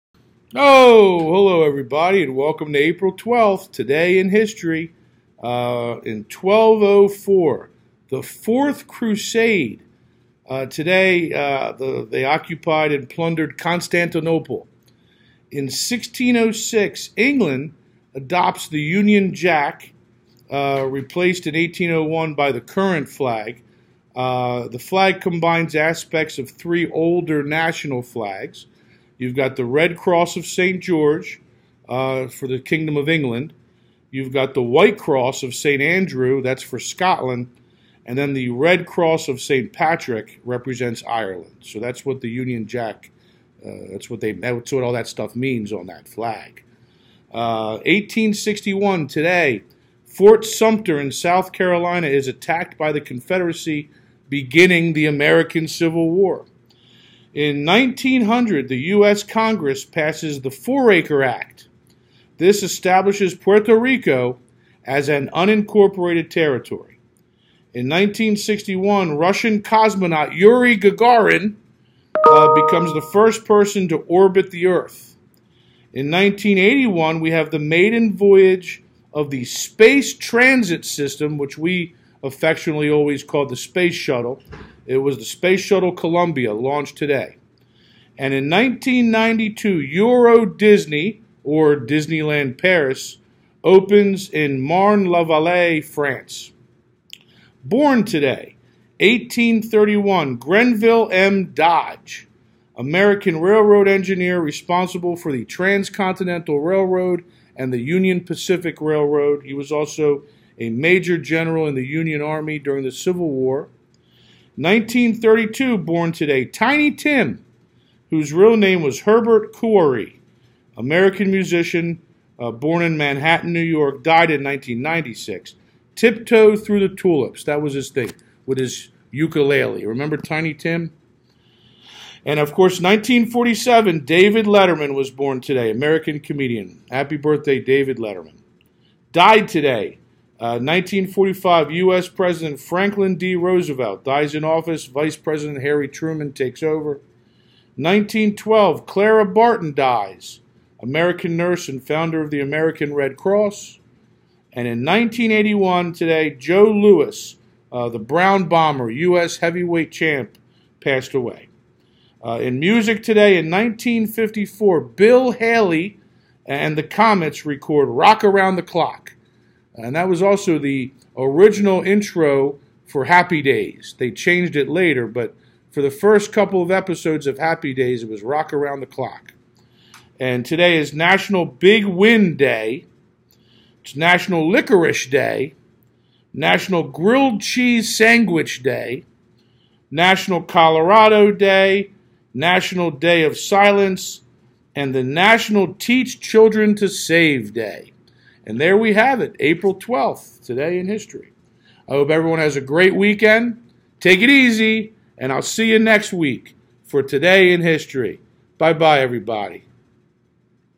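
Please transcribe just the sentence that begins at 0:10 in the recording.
Uh, today, uh, the, they occupied and plundered Constantinople.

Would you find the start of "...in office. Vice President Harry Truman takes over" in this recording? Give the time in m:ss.
2:24.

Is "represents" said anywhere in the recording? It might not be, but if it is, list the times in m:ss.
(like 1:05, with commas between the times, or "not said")
0:40.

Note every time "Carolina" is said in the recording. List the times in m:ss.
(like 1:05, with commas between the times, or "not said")
0:51.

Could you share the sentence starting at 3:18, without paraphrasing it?
And there we have it, April 12th, today in history.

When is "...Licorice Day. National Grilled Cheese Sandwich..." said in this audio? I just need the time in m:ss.
3:04.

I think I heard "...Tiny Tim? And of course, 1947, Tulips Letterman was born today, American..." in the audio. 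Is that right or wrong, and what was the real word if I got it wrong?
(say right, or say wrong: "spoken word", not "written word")
wrong: "David", not "Tulips".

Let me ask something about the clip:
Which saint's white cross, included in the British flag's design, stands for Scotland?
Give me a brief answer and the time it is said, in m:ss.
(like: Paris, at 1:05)
St. Andrew, at 0:35.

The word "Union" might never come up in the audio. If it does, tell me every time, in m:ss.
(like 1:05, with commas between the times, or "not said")
0:18, 0:42, 1:47, 1:51.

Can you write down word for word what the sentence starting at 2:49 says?
And that was also the original intro for Happy Days.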